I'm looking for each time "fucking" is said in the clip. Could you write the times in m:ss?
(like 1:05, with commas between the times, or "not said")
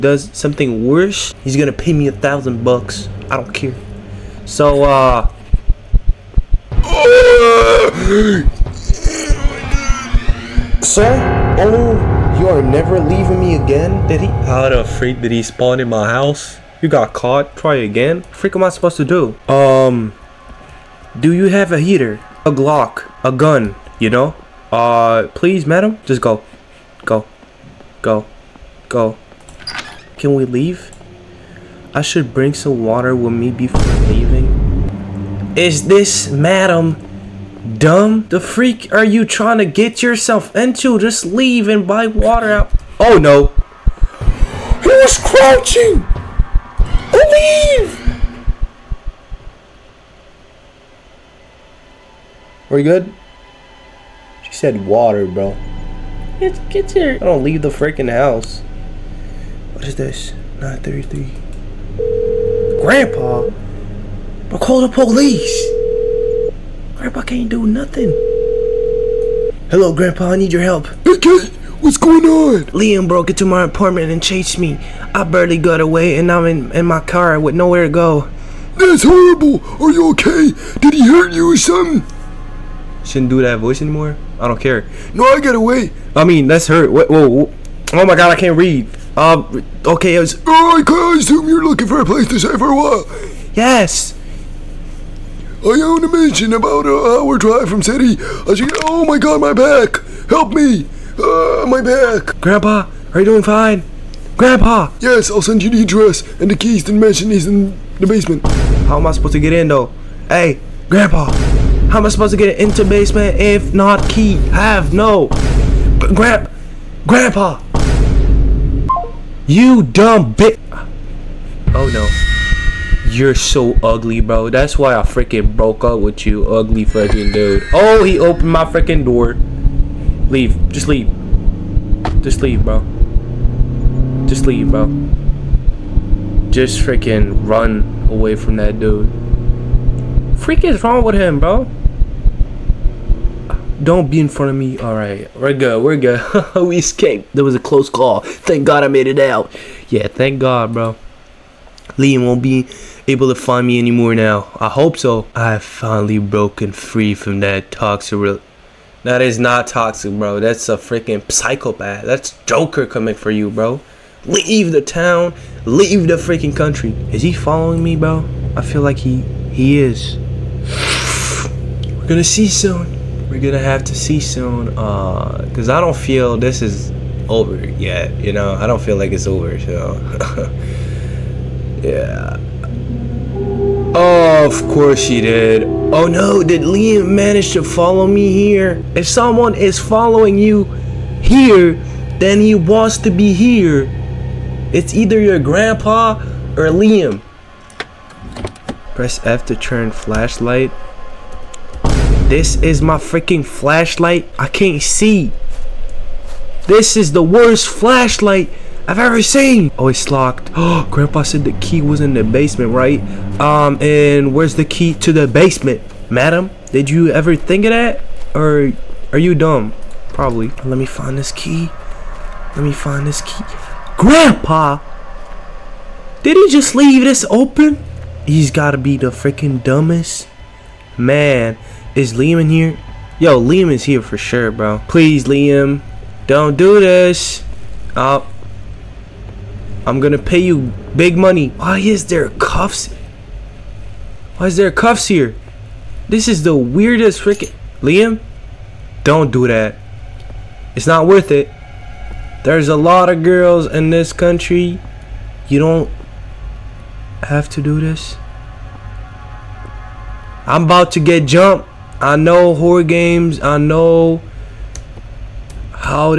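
2:06.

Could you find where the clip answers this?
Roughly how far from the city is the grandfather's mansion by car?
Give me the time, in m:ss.
1:36.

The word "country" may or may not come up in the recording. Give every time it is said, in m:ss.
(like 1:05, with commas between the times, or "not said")
2:46, 4:14.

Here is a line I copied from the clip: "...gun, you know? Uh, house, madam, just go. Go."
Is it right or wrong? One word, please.
wrong.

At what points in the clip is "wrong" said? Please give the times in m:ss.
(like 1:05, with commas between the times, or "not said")
2:20.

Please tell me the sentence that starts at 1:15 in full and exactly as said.
I barely got away and I'm in, in my car with nowhere to go.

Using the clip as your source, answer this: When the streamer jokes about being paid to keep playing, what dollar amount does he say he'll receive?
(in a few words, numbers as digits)
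$1,000.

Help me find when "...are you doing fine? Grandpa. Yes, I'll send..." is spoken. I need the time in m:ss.
1:43.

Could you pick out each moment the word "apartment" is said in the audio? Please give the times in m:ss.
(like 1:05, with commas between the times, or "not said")
1:13.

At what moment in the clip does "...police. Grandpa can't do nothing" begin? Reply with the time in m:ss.
1:04.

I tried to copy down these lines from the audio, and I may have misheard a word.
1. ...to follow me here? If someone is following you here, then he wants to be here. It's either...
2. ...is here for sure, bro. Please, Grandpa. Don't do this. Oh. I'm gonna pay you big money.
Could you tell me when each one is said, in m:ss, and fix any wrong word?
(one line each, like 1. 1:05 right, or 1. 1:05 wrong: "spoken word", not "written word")
1. 3:07 right
2. 3:53 wrong: "Liam", not "Grandpa".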